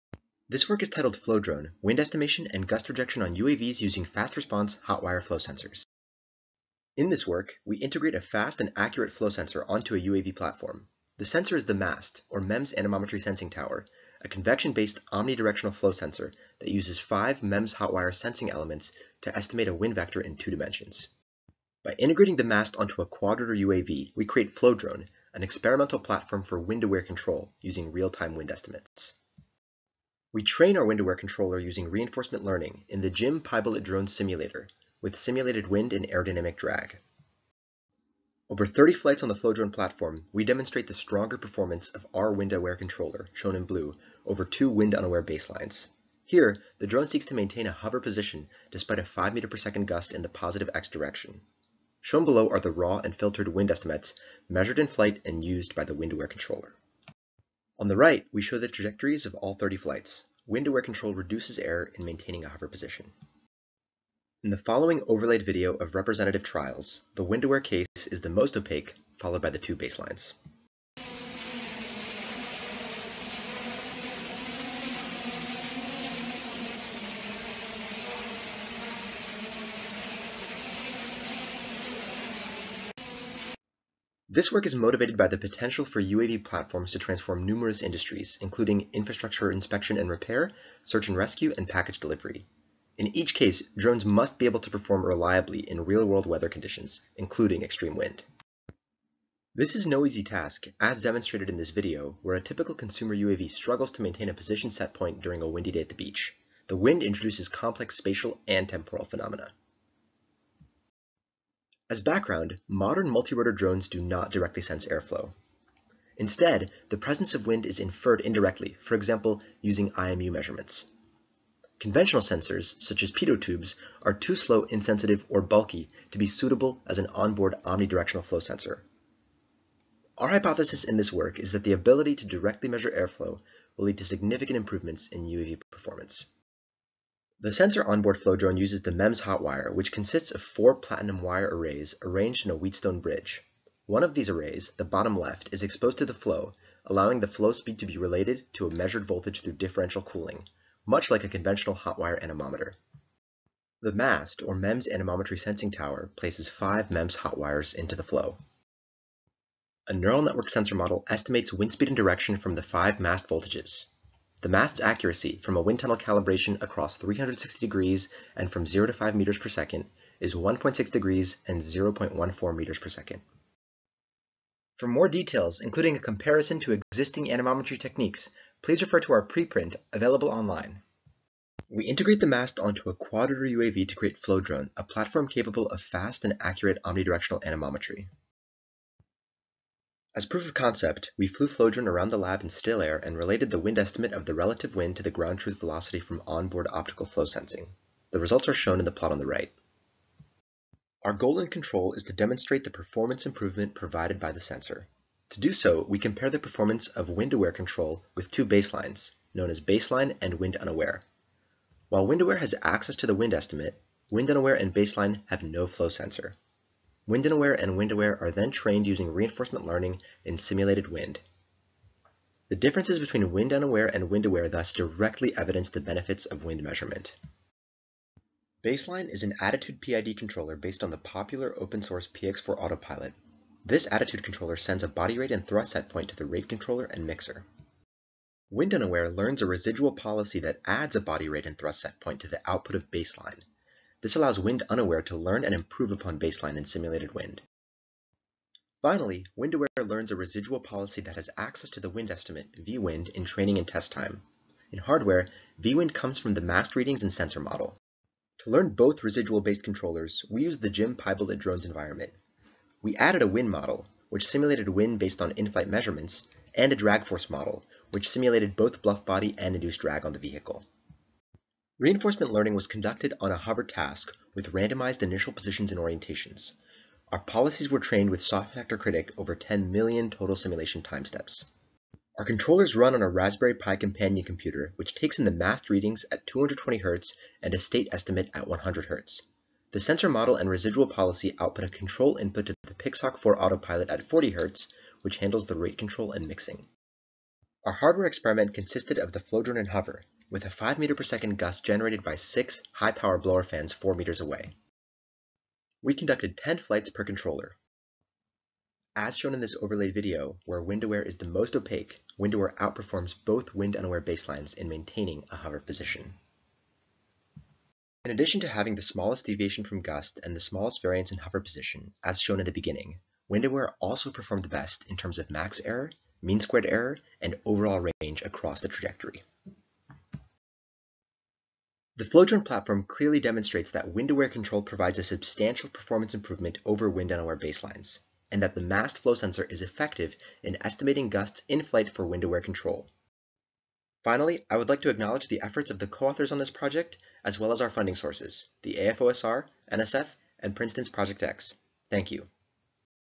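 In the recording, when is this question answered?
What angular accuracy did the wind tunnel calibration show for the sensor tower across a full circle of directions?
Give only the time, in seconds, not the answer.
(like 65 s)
170 s.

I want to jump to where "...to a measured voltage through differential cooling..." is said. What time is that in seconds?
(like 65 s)
148 s.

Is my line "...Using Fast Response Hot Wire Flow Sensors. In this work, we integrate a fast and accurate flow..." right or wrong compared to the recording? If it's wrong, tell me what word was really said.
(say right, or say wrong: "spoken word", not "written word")
right.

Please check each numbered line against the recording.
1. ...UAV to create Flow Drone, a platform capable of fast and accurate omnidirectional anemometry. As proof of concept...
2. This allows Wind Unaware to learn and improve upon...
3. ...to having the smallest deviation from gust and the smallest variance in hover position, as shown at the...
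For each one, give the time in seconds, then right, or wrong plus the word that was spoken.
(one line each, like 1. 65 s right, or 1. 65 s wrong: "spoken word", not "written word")
1. 183 s right
2. 244 s right
3. 318 s right.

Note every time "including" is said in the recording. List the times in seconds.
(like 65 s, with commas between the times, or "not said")
88 s, 97 s, 175 s.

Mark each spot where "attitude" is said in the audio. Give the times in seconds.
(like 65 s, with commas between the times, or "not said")
229 s, 233 s.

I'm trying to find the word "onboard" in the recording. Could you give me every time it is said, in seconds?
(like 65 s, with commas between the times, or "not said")
127 s, 137 s, 196 s.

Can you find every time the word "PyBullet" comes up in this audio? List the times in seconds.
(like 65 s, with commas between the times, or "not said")
33 s, 260 s.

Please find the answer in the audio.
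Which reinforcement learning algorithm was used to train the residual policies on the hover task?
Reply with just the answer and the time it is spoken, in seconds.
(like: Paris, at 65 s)
Soft actor critic, at 278 s.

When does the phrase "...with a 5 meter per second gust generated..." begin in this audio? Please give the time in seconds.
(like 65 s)
300 s.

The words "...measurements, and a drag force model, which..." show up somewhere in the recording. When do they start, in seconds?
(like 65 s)
265 s.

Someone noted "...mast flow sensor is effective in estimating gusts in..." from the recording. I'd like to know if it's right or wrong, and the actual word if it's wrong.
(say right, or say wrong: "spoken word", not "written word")
right.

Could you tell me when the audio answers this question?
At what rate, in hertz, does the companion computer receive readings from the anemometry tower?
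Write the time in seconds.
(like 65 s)
286 s.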